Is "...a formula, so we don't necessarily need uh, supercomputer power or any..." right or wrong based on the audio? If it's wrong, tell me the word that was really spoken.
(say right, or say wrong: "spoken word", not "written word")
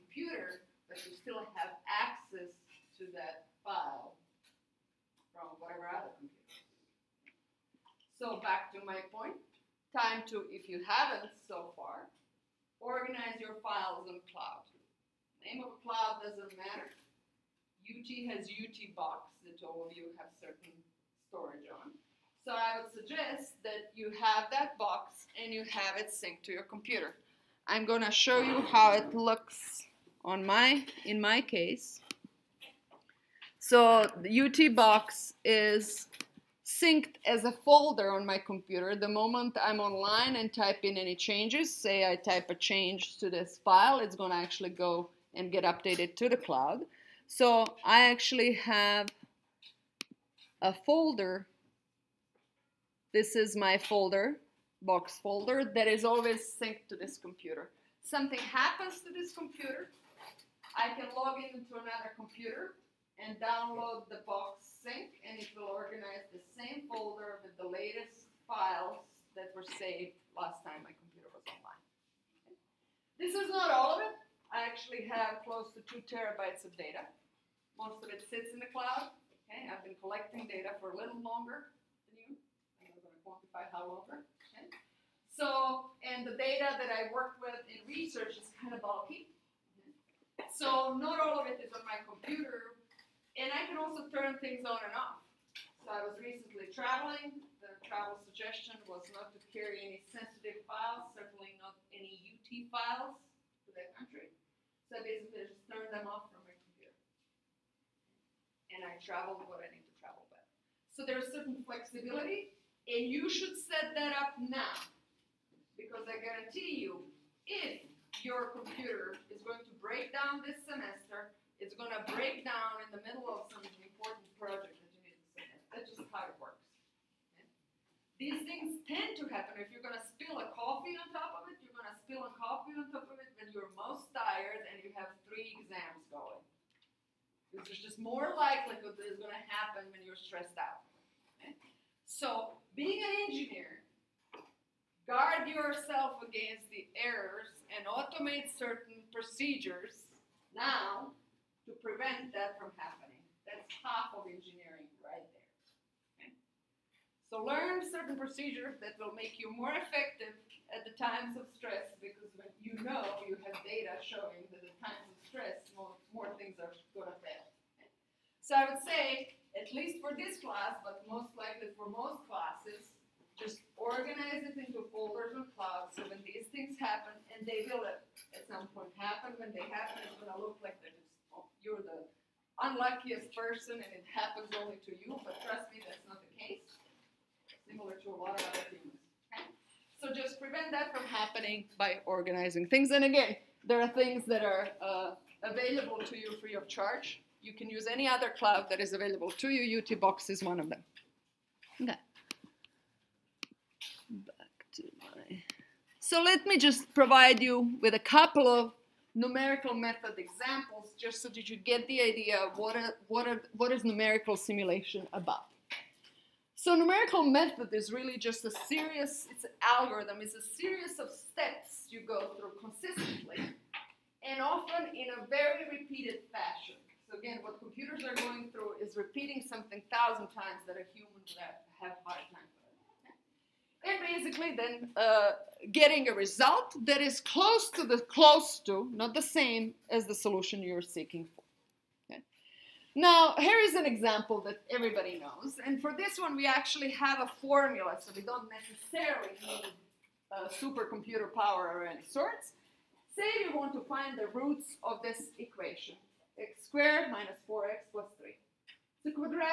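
right.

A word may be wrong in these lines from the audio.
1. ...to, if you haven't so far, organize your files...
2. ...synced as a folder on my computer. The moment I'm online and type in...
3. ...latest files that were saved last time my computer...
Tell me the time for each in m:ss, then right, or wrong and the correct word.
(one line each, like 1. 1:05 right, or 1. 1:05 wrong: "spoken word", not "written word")
1. 0:10 right
2. 0:36 right
3. 1:07 right.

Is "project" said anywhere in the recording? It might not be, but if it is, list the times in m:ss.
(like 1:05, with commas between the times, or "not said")
2:04.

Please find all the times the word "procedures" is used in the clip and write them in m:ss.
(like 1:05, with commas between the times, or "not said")
2:29, 2:38.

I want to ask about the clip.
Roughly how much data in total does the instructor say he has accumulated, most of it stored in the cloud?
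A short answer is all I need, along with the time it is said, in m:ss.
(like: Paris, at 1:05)
2 terabytes, at 1:15.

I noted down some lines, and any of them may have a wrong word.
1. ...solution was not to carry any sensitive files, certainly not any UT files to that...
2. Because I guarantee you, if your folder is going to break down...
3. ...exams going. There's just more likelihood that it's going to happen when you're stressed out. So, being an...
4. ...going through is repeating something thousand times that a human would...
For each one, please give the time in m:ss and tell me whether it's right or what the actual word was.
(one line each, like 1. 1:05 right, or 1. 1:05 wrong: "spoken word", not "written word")
1. 1:38 wrong: "suggestion", not "solution"
2. 1:55 wrong: "computer", not "folder"
3. 2:15 right
4. 3:48 right.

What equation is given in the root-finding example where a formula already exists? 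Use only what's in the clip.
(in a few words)
x^2 - 4x + 3.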